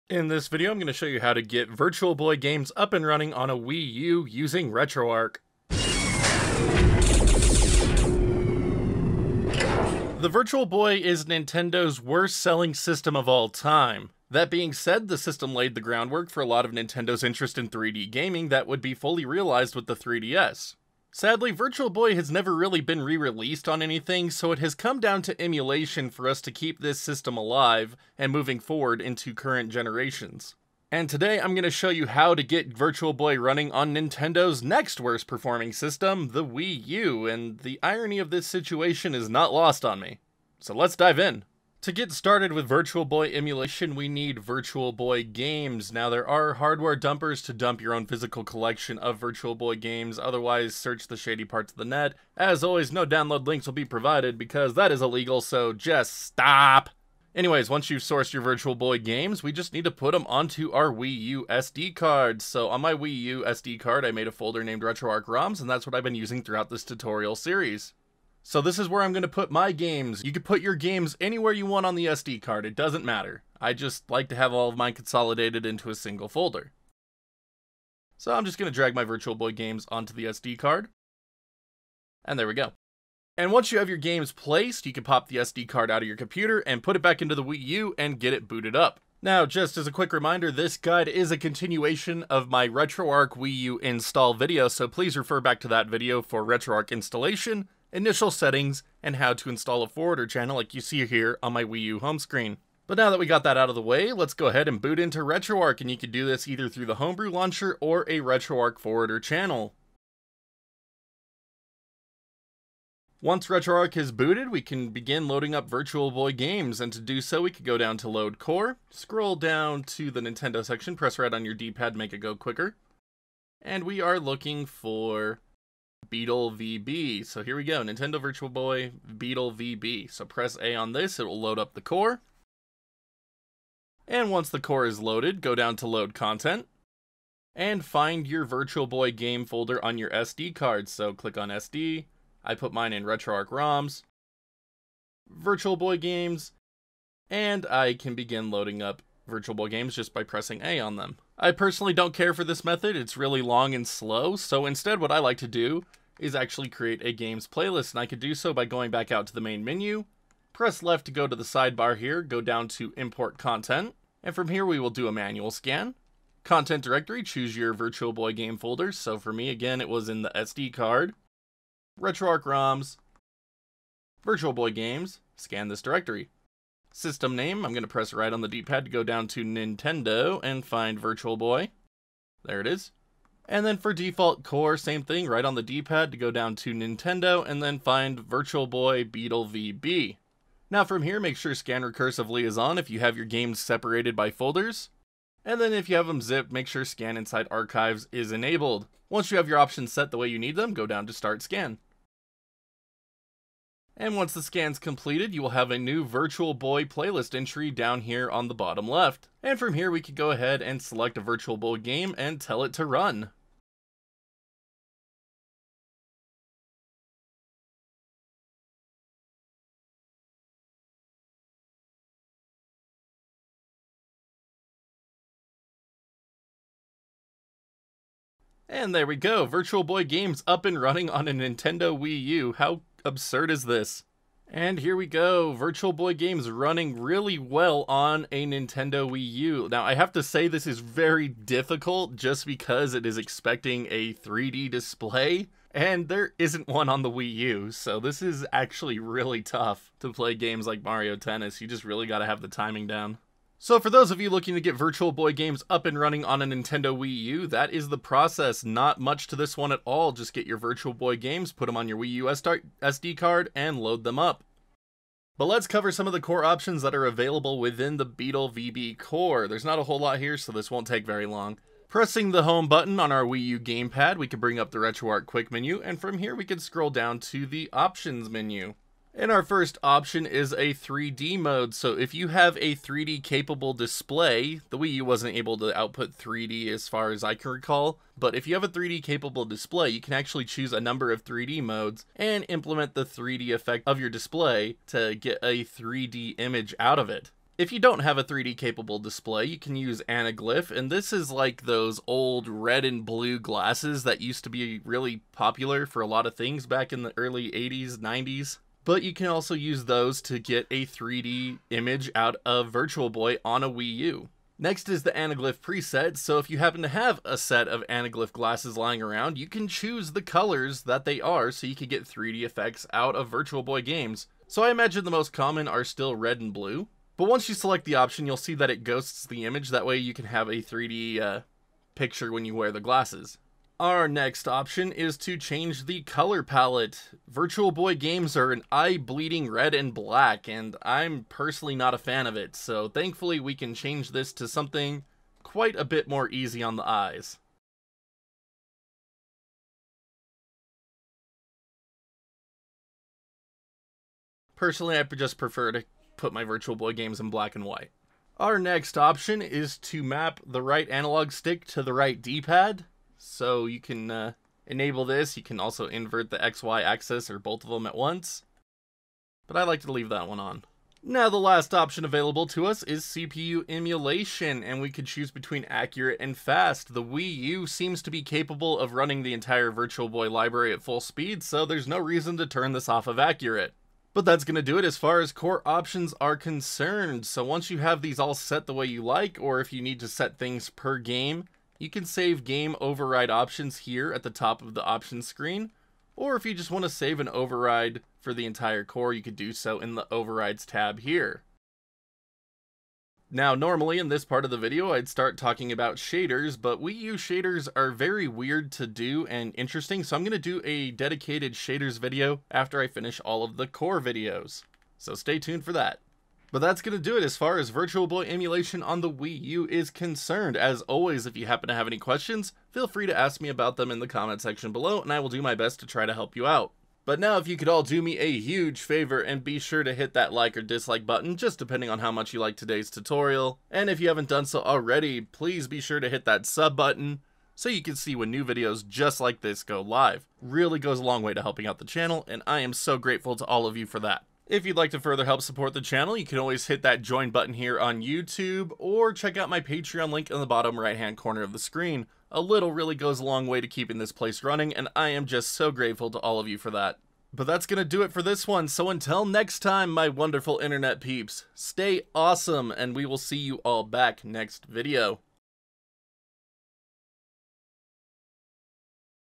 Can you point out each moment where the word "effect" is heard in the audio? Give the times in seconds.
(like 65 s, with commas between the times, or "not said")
293 s, 322 s.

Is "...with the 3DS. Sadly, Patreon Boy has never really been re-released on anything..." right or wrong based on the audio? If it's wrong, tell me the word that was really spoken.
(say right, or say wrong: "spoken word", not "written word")
wrong: "Virtual", not "Patreon".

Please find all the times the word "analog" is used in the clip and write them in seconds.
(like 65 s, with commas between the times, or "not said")
360 s.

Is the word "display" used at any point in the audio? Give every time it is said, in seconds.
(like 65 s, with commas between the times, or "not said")
244 s, 283 s, 289 s, 294 s, 298 s.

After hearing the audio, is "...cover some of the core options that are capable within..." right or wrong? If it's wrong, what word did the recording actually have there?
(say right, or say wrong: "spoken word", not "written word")
wrong: "available", not "capable".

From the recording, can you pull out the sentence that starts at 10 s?
The Virtual Boy is Nintendo's worst selling system of all time.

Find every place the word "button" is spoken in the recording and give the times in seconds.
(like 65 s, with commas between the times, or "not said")
272 s, 431 s, 436 s, 447 s.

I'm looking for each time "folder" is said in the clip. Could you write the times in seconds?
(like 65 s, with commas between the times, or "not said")
64 s, 76 s, 139 s, 168 s, 194 s.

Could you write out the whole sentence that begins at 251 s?
You just really gotta have the timing down.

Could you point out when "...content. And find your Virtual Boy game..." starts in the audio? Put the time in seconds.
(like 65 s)
136 s.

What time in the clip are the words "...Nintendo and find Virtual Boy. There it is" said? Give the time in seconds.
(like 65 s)
179 s.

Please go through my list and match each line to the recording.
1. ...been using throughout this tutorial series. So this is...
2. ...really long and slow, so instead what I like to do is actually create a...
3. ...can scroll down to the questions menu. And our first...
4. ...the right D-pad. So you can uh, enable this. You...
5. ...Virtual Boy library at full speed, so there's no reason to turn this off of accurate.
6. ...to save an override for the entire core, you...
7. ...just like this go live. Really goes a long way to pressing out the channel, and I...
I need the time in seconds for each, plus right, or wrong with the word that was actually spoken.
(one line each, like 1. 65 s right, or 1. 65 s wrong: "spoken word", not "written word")
1. 66 s right
2. 153 s right
3. 276 s wrong: "options", not "questions"
4. 361 s right
5. 379 s right
6. 396 s right
7. 438 s wrong: "helping", not "pressing".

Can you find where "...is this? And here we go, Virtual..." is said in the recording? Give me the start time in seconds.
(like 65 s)
233 s.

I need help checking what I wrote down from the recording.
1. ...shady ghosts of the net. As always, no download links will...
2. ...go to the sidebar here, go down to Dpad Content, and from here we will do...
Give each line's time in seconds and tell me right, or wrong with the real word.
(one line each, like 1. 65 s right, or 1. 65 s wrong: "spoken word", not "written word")
1. 51 s wrong: "parts", not "ghosts"
2. 161 s wrong: "Import", not "Dpad".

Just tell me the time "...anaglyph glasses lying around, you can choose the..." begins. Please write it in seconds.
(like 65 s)
317 s.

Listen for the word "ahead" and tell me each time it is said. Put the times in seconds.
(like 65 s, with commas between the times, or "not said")
104 s, 210 s.